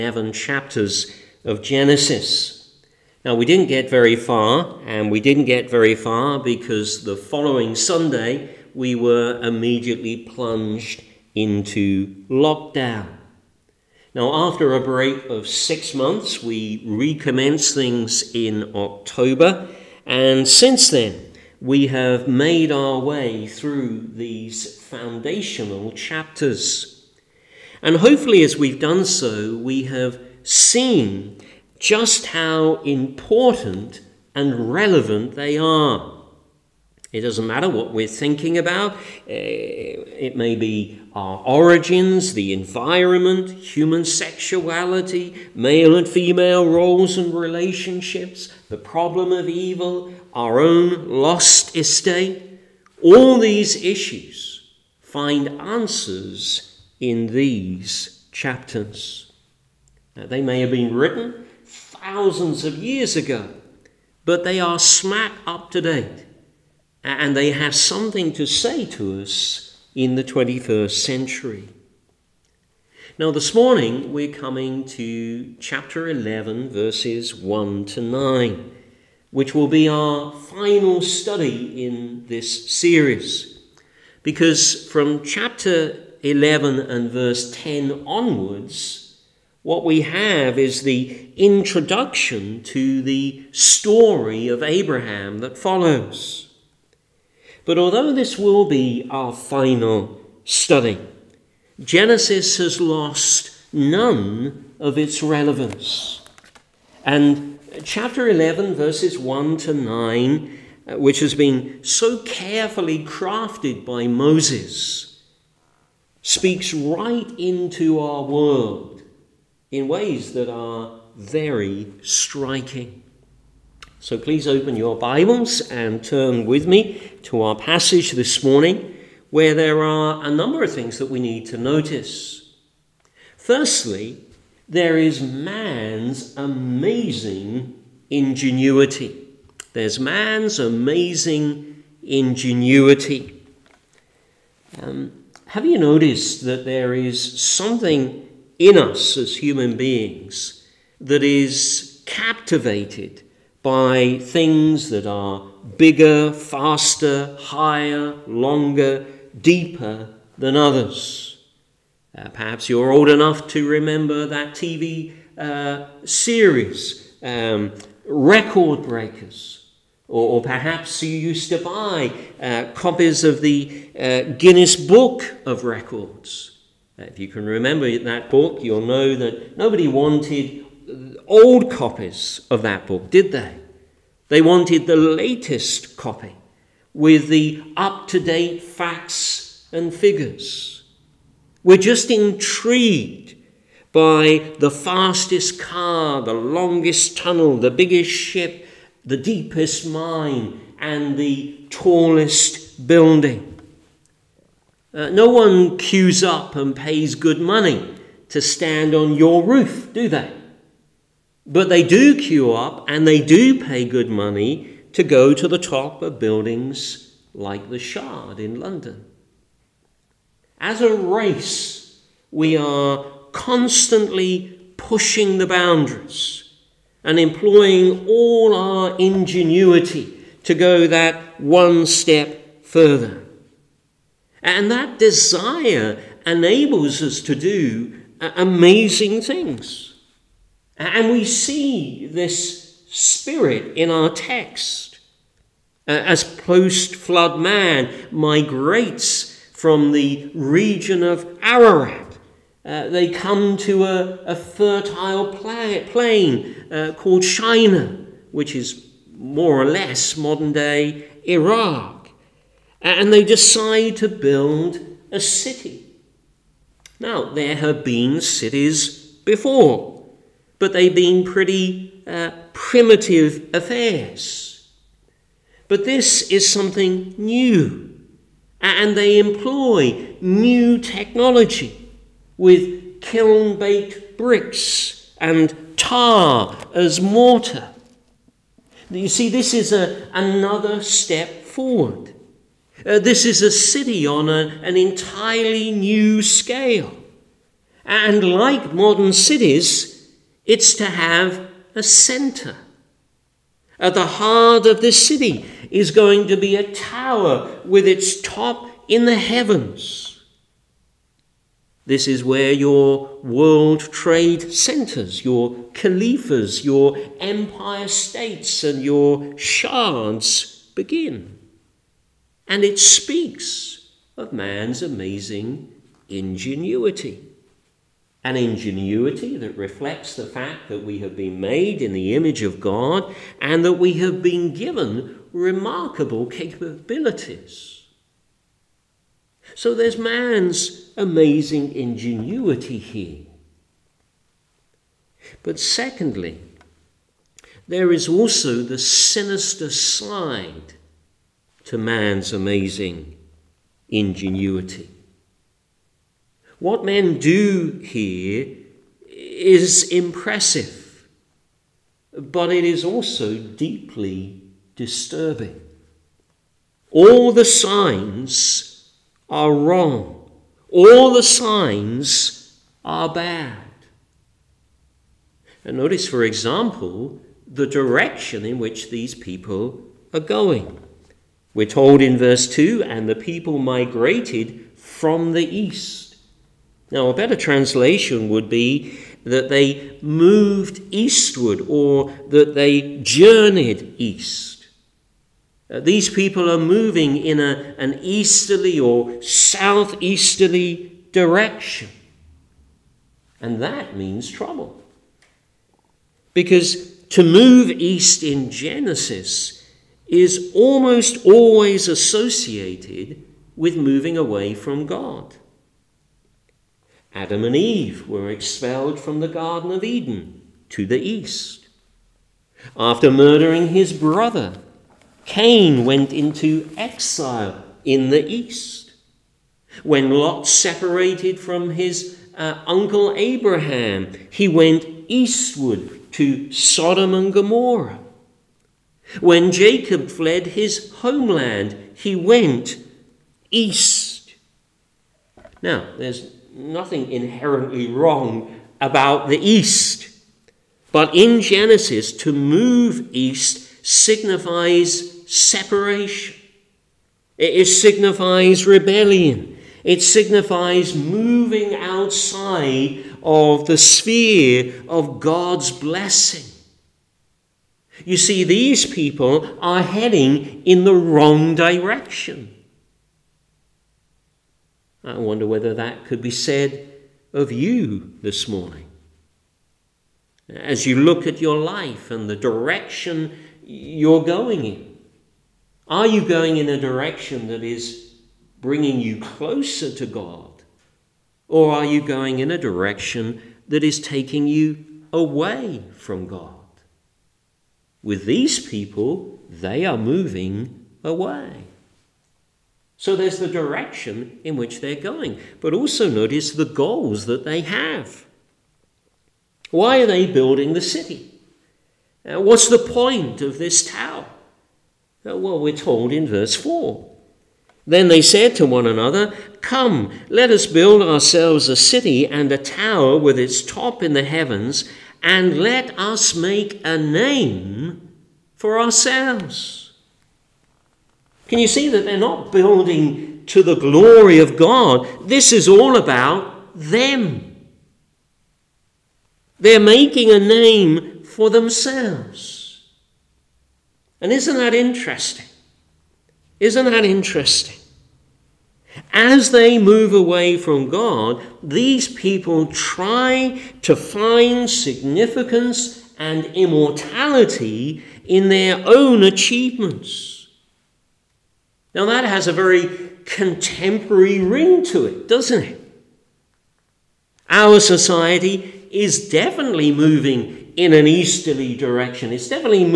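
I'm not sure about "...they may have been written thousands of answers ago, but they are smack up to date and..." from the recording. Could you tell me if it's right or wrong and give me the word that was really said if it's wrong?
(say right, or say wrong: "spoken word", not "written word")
wrong: "years", not "answers".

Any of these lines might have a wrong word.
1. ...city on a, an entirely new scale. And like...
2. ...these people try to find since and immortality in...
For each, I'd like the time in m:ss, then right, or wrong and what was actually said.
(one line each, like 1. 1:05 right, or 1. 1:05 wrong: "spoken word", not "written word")
1. 4:53 right
2. 9:11 wrong: "significance", not "since".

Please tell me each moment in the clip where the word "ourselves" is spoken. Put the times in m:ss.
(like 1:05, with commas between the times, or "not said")
8:41, 8:48.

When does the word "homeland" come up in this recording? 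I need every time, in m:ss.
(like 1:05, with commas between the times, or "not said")
7:20.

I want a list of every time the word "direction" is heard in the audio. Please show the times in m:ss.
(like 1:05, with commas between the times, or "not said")
6:17, 6:41, 7:51, 8:02, 8:06, 8:12, 8:23, 9:31.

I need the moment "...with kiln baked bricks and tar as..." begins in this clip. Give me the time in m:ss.
4:42.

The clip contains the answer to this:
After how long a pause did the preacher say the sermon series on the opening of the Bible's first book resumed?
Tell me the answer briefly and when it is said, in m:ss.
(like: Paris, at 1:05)
Six months, at 0:15.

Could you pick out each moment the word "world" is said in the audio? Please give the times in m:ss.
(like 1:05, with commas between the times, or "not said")
1:58, 5:13.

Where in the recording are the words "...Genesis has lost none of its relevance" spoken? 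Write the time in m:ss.
1:41.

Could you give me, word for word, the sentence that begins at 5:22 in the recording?
And it speaks of man's amazing ingenuity.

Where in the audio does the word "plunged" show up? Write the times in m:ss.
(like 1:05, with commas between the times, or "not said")
0:10.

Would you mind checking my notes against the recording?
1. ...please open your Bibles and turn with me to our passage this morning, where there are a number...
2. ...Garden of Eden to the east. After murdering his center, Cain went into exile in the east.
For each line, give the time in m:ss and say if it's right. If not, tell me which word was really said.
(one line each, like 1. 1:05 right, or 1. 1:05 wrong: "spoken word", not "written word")
1. 2:04 right
2. 6:59 wrong: "brother", not "center".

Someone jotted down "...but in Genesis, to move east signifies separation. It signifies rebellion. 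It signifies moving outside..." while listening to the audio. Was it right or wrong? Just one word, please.
right.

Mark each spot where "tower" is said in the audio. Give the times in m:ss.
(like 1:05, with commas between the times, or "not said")
5:06, 8:33, 8:42.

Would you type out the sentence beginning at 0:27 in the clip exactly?
And hopefully, as we've done so, we have seen just how important and relevant they are.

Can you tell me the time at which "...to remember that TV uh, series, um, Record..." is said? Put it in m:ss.
2:43.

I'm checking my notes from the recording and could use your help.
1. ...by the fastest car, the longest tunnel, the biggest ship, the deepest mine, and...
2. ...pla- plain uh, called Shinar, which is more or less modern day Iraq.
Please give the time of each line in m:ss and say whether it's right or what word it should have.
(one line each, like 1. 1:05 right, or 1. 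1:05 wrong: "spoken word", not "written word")
1. 3:13 right
2. 4:15 right.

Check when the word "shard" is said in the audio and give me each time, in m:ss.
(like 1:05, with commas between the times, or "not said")
3:37, 5:19.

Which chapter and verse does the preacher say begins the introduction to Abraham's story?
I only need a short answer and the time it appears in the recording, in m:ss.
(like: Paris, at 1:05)
Chapter 11, verse 10, at 1:25.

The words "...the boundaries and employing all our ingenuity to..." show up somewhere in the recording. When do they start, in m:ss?
3:45.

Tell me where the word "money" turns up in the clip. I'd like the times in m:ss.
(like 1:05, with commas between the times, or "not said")
3:27, 3:34.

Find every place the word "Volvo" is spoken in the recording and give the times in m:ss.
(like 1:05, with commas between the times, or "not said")
not said.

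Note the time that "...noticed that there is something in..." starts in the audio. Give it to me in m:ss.
2:25.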